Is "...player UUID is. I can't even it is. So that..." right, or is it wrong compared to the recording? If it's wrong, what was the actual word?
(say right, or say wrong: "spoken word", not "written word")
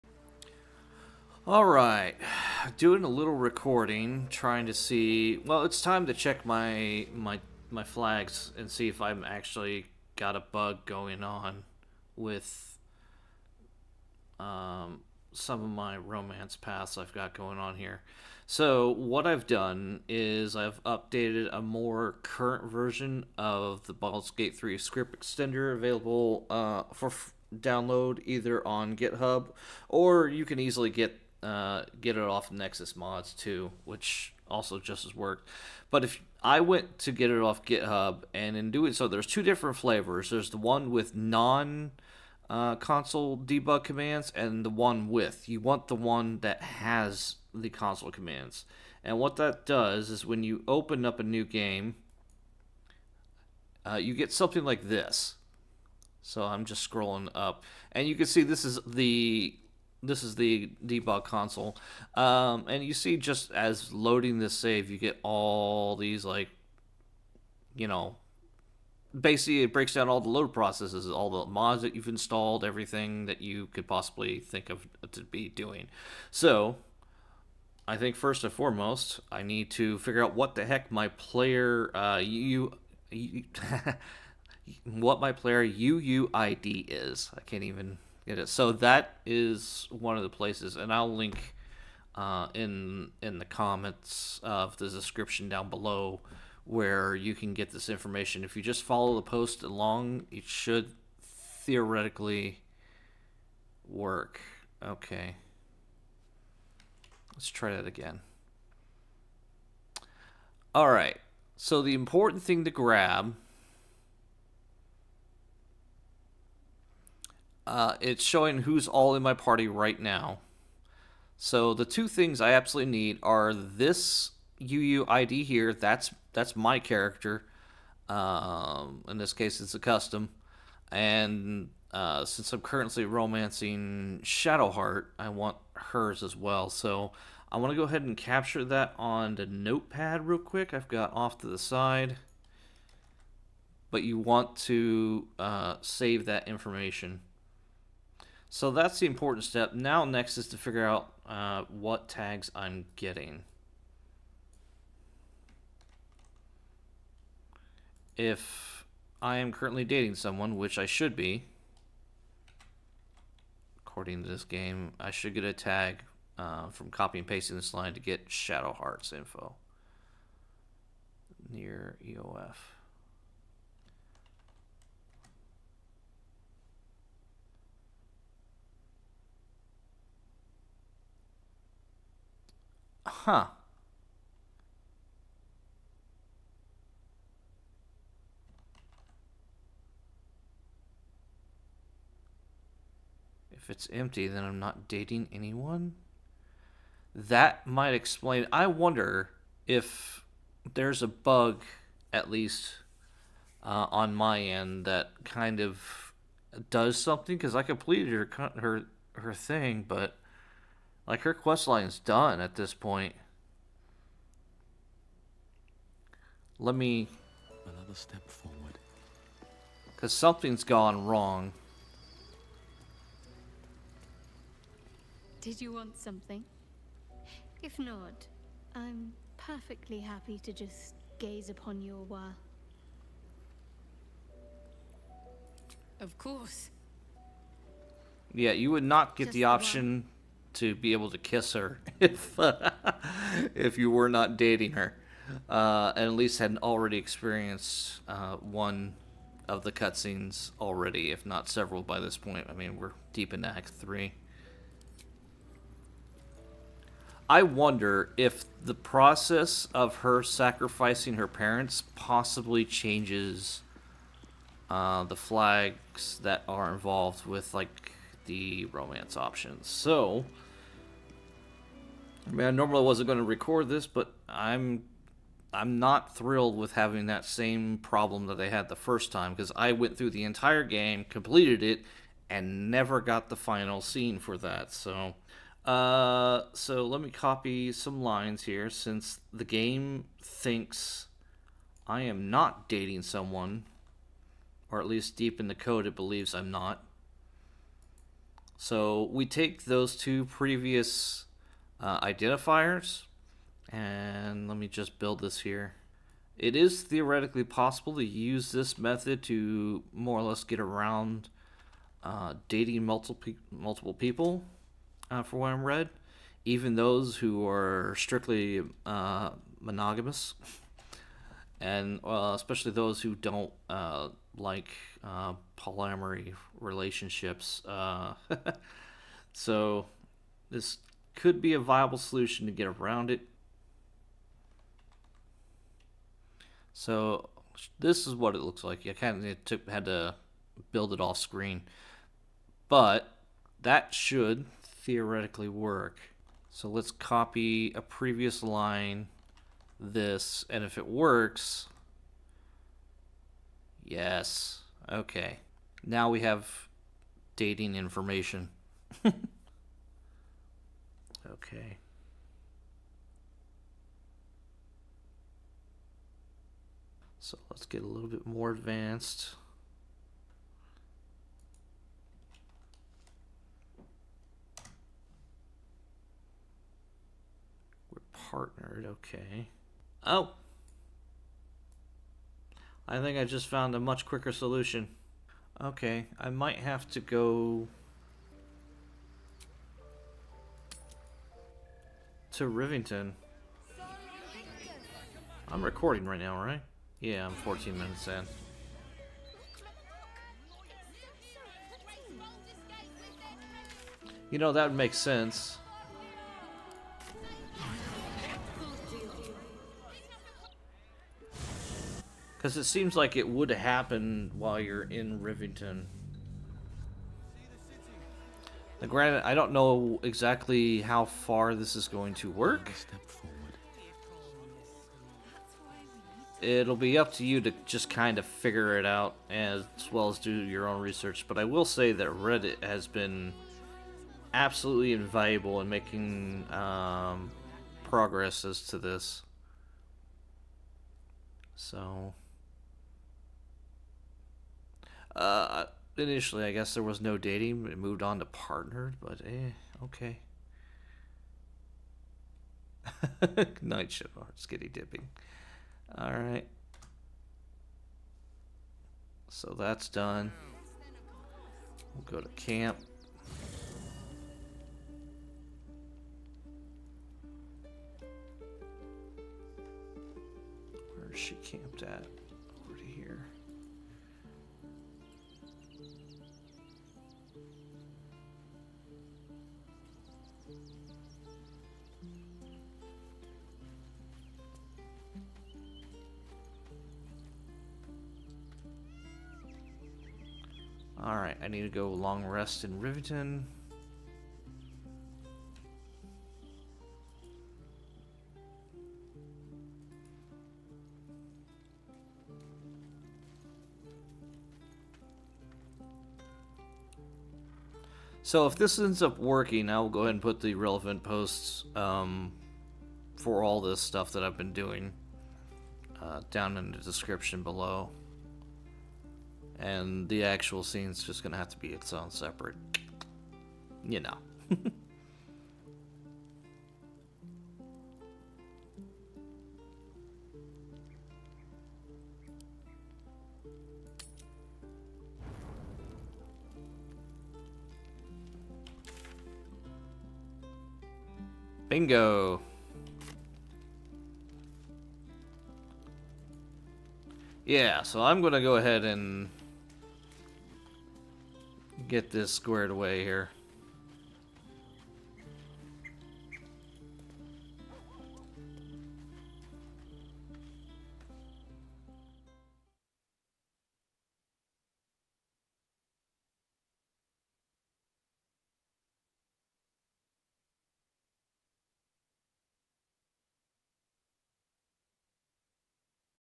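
right.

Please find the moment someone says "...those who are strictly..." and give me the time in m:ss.
5:16.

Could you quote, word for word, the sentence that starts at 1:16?
So, I think first and foremost, I need to figure out what the heck my player uh, you.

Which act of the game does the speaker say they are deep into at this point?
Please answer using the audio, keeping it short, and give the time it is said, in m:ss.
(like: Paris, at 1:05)
Act Three, at 4:13.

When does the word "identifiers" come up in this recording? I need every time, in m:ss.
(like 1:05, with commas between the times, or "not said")
5:02.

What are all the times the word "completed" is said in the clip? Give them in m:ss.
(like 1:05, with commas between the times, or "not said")
3:27, 4:41.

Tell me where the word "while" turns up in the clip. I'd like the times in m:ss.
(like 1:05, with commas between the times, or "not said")
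3:52, 6:54.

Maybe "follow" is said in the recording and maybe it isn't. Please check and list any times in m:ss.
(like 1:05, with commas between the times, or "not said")
1:38.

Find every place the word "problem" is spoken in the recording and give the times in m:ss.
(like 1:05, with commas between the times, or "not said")
4:37.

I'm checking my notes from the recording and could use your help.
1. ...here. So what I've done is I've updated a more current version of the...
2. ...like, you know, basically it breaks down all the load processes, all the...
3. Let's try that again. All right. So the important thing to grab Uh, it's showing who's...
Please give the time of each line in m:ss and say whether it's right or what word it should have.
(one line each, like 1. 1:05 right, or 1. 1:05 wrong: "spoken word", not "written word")
1. 0:17 right
2. 1:06 right
3. 1:47 right.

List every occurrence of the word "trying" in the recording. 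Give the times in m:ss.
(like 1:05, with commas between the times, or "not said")
0:04.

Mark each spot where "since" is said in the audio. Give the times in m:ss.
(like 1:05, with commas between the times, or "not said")
2:12, 4:48.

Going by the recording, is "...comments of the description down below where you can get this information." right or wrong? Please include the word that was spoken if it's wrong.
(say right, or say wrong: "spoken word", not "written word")
right.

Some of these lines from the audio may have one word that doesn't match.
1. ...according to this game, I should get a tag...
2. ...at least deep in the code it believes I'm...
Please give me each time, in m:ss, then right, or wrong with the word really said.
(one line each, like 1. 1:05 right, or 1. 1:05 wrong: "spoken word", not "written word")
1. 2:43 right
2. 4:54 right.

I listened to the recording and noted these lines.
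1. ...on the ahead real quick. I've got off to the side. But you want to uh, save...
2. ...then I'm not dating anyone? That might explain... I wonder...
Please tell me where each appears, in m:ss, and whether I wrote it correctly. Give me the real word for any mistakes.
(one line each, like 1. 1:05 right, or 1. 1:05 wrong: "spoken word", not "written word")
1. 2:18 wrong: "notepad", not "ahead"
2. 3:14 right.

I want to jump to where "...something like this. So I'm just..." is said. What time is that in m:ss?
0:54.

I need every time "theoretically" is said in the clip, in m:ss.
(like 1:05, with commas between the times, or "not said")
1:41, 5:06, 5:44.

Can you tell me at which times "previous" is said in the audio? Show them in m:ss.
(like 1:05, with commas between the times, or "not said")
5:00, 5:47.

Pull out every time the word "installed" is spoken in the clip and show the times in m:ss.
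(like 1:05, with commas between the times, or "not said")
1:12.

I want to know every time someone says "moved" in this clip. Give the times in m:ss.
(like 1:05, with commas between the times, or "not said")
7:27.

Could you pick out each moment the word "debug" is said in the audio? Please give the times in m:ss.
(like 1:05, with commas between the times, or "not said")
0:43, 1:00.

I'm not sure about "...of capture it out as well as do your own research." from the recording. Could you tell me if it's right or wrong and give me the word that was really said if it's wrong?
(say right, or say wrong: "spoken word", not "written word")
wrong: "figure", not "capture".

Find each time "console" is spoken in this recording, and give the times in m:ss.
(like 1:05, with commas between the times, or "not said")
0:42, 0:47, 1:01.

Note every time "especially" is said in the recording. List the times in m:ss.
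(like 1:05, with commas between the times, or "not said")
5:22.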